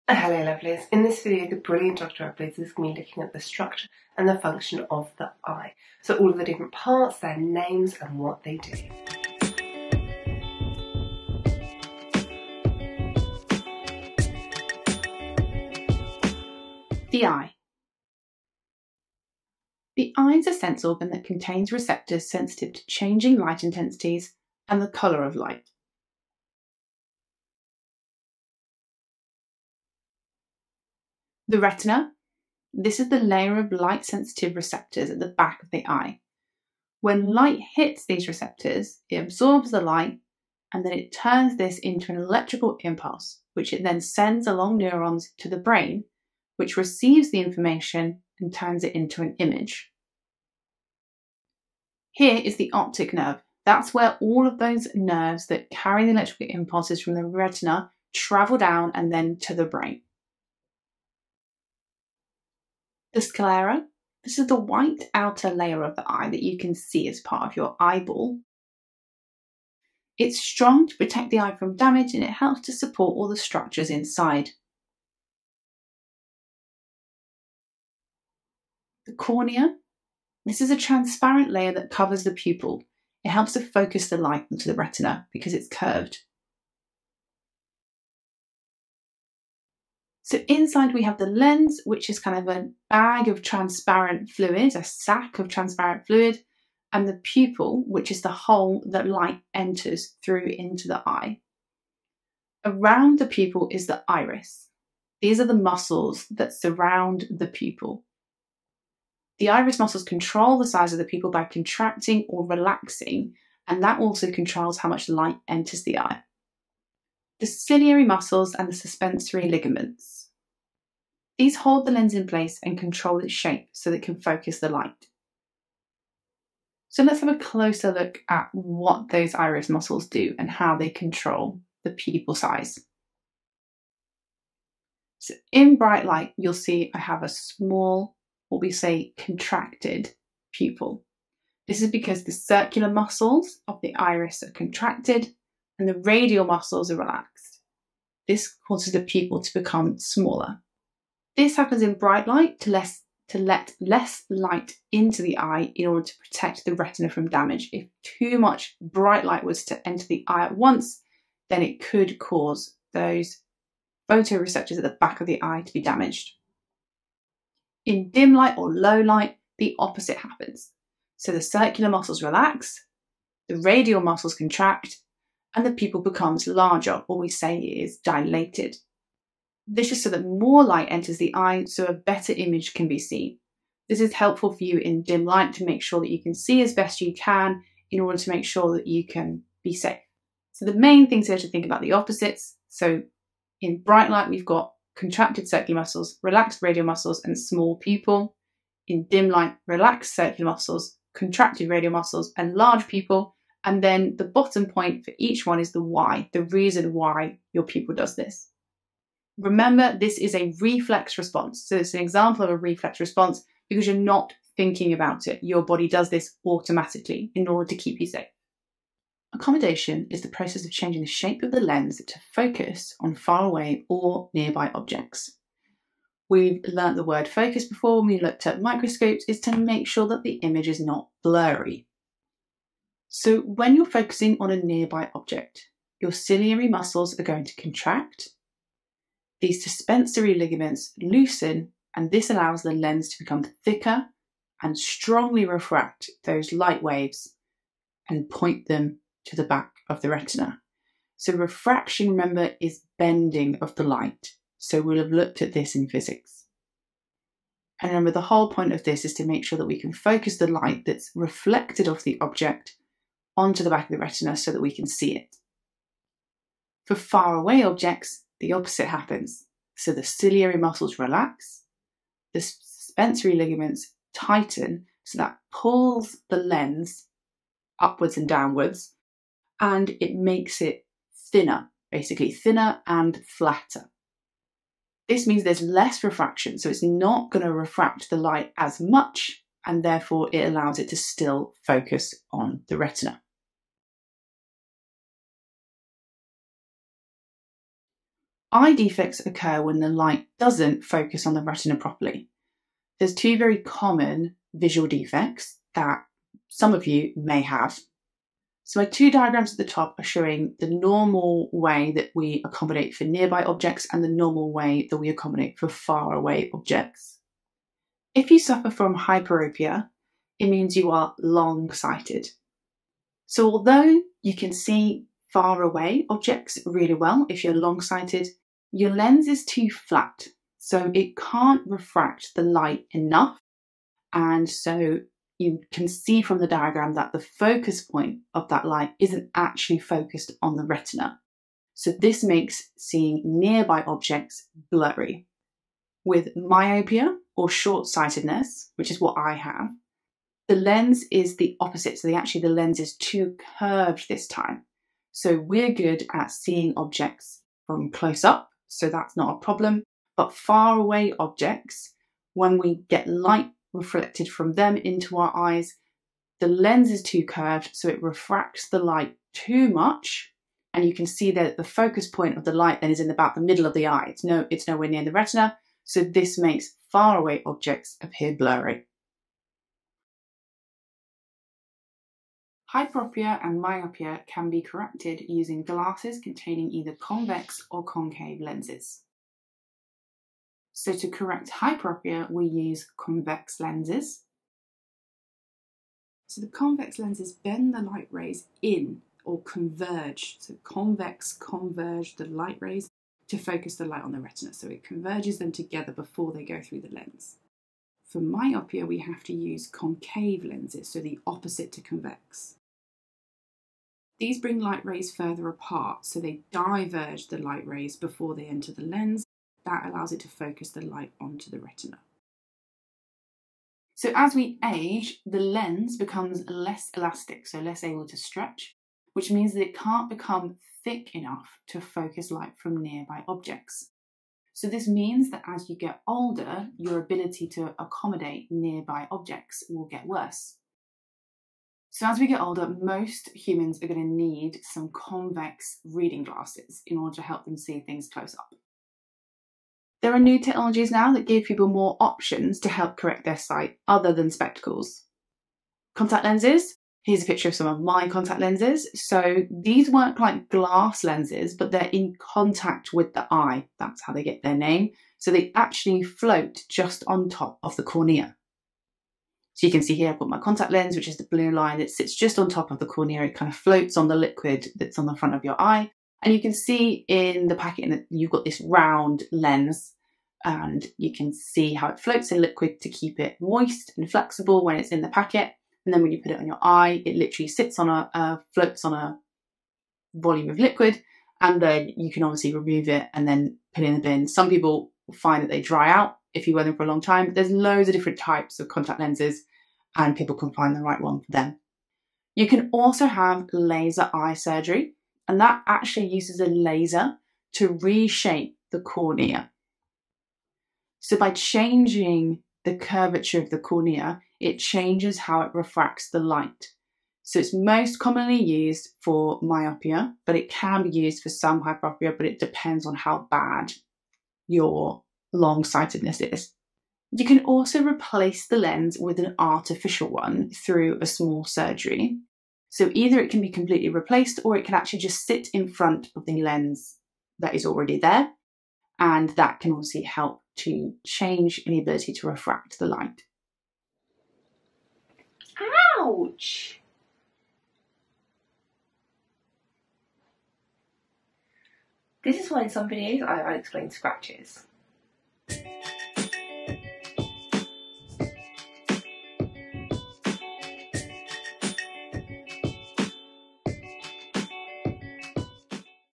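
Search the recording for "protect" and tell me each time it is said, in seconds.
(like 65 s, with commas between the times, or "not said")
70 s, 156 s.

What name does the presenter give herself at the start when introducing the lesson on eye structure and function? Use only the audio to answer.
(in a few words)
Dr. Uploads.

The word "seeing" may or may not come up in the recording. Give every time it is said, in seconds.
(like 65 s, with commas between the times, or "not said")
342 s, 356 s.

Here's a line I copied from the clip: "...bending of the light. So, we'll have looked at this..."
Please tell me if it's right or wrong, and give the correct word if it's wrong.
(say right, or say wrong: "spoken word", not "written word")
right.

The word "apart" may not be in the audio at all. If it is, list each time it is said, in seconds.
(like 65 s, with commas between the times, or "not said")
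415 s.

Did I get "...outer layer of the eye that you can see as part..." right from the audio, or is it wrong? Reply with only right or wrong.
right.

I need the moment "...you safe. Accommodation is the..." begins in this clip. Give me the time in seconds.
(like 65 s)
218 s.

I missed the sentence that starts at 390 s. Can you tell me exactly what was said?
So to correct hyperopia, we use convex lenses.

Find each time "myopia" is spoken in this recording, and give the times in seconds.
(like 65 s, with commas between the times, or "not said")
346 s, 383 s, 408 s, 519 s.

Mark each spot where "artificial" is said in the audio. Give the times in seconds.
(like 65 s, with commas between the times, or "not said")
529 s.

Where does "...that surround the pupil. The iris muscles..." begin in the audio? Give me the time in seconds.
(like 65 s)
106 s.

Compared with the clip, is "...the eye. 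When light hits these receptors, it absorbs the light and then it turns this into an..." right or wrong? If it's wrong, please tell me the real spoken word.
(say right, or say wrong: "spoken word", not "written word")
right.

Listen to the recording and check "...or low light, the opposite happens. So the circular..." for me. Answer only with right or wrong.
right.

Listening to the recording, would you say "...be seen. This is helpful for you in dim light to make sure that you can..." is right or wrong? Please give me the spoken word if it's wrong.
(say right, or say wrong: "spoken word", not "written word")
right.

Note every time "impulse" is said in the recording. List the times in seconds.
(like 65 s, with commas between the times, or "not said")
42 s, 56 s.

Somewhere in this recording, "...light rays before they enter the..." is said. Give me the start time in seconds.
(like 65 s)
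417 s.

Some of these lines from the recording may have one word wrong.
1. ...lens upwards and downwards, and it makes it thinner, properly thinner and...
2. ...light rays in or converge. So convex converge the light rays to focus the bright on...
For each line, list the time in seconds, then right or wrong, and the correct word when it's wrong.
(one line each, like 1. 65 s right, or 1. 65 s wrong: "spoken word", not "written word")
1. 276 s wrong: "basically", not "properly"
2. 397 s wrong: "light", not "bright".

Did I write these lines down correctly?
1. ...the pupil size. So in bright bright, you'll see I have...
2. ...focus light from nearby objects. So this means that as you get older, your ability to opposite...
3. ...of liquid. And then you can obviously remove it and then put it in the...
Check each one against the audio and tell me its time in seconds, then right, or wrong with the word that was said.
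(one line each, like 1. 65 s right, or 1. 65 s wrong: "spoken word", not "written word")
1. 131 s wrong: "light", not "bright"
2. 431 s wrong: "accommodate", not "opposite"
3. 490 s right.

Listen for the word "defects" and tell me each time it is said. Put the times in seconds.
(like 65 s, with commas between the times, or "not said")
298 s, 304 s.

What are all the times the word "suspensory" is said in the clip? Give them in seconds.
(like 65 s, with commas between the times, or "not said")
118 s, 239 s, 272 s.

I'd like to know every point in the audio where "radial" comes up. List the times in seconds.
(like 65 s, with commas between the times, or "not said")
146 s, 173 s, 196 s, 201 s.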